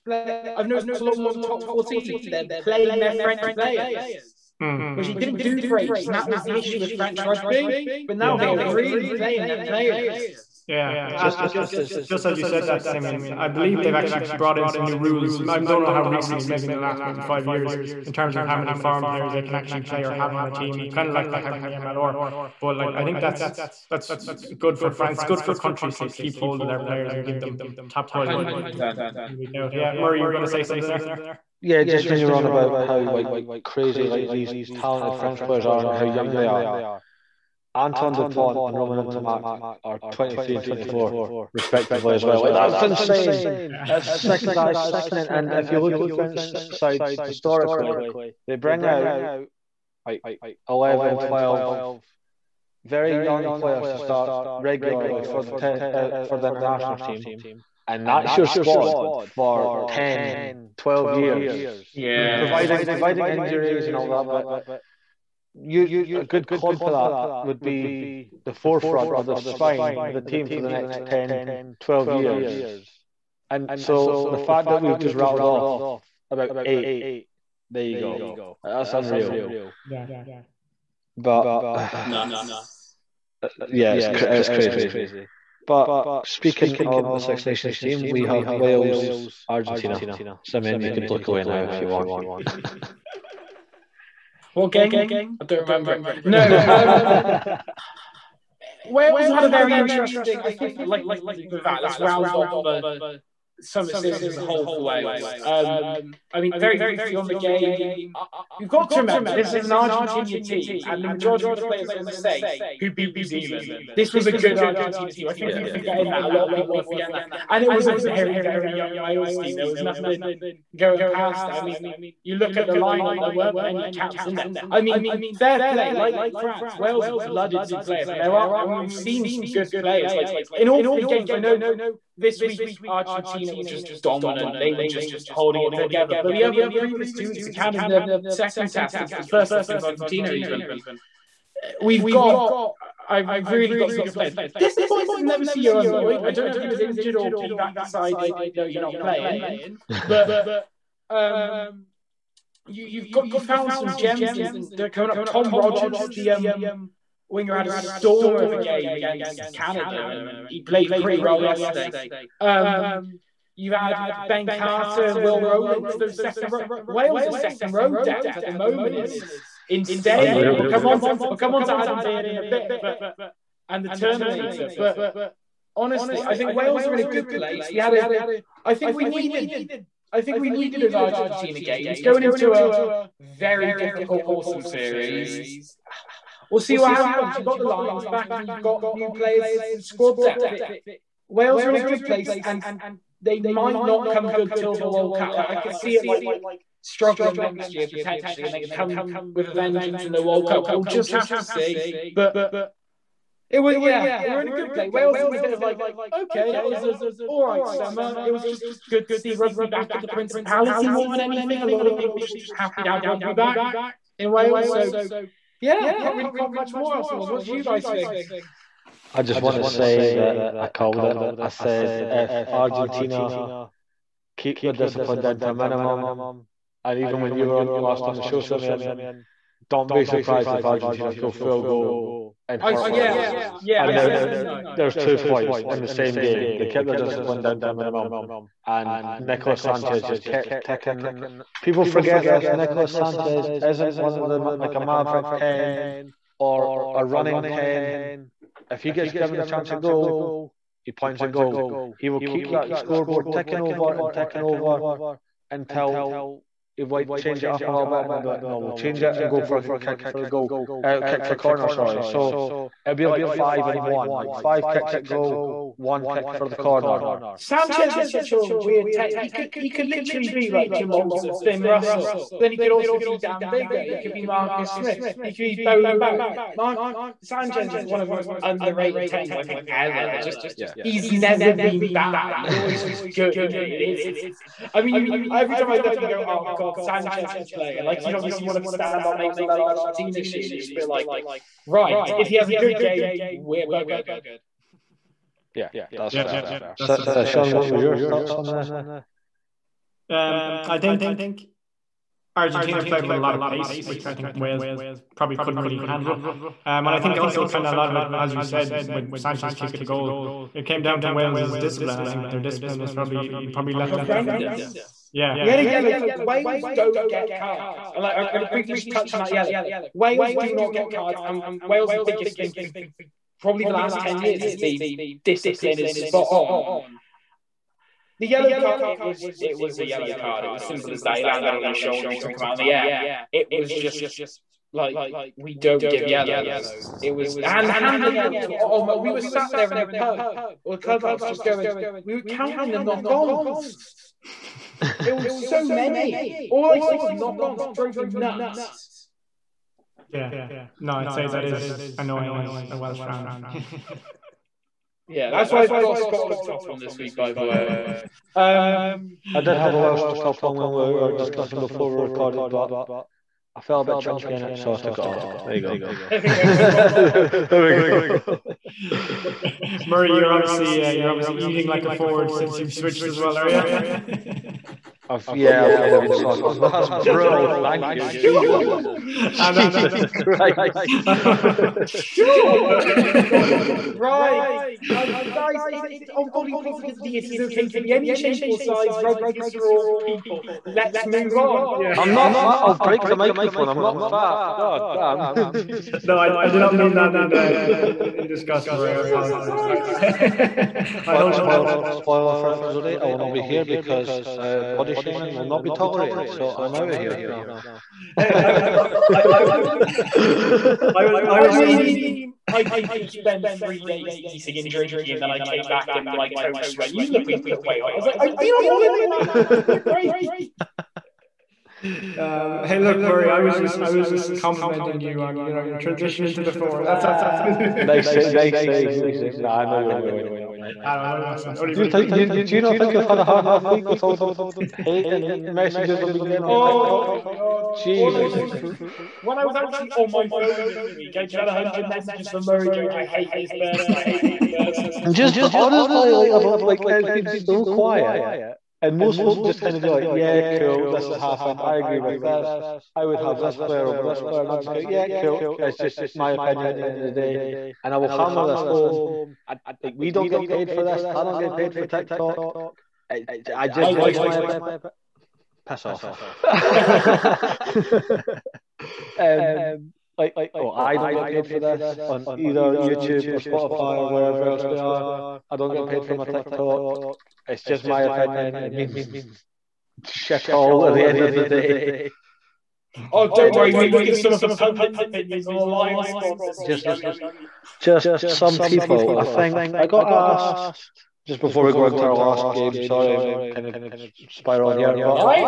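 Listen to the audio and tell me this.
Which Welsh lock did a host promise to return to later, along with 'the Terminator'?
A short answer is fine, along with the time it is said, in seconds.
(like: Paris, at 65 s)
Adam Beard, at 171 s.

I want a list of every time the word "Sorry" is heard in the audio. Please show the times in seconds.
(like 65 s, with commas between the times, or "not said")
261 s, 492 s.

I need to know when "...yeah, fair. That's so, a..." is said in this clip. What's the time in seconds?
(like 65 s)
296 s.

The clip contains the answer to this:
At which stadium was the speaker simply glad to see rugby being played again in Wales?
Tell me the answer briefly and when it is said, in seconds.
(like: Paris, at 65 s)
Principality, at 210 s.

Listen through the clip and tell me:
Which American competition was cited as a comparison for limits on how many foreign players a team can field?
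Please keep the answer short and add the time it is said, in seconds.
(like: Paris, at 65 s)
MLR, at 21 s.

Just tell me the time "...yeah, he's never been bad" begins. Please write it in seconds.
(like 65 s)
280 s.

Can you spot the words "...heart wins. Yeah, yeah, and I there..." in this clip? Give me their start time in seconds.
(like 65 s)
232 s.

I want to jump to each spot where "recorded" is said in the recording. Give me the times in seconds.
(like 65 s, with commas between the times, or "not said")
362 s.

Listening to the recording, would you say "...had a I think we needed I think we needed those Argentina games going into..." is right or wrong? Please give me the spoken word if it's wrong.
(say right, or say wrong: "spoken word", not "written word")
right.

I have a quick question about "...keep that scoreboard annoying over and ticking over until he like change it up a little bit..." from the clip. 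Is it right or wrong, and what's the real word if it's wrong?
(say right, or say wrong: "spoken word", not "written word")
wrong: "ticking", not "annoying".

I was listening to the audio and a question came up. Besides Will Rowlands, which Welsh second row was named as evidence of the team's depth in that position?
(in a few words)
Ben Carter.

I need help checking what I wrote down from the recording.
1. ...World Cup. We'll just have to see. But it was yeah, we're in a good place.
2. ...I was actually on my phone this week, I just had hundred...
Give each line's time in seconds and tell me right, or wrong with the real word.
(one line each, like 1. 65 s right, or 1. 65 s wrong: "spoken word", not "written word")
1. 200 s right
2. 439 s right.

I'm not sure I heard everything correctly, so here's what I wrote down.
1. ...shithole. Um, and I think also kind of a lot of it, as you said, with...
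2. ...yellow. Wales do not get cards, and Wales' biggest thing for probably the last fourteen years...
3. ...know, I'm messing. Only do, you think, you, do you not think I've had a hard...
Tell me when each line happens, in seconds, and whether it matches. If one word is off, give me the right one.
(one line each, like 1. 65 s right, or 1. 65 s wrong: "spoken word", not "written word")
1. 305 s wrong: "handle", not "shithole"
2. 319 s wrong: "ten", not "fourteen"
3. 430 s right.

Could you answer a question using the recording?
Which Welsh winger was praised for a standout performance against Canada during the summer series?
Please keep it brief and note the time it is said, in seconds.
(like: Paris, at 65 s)
Tom Rogers, at 155 s.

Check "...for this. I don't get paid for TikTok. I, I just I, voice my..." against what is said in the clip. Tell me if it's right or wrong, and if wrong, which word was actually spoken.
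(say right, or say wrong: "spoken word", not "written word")
right.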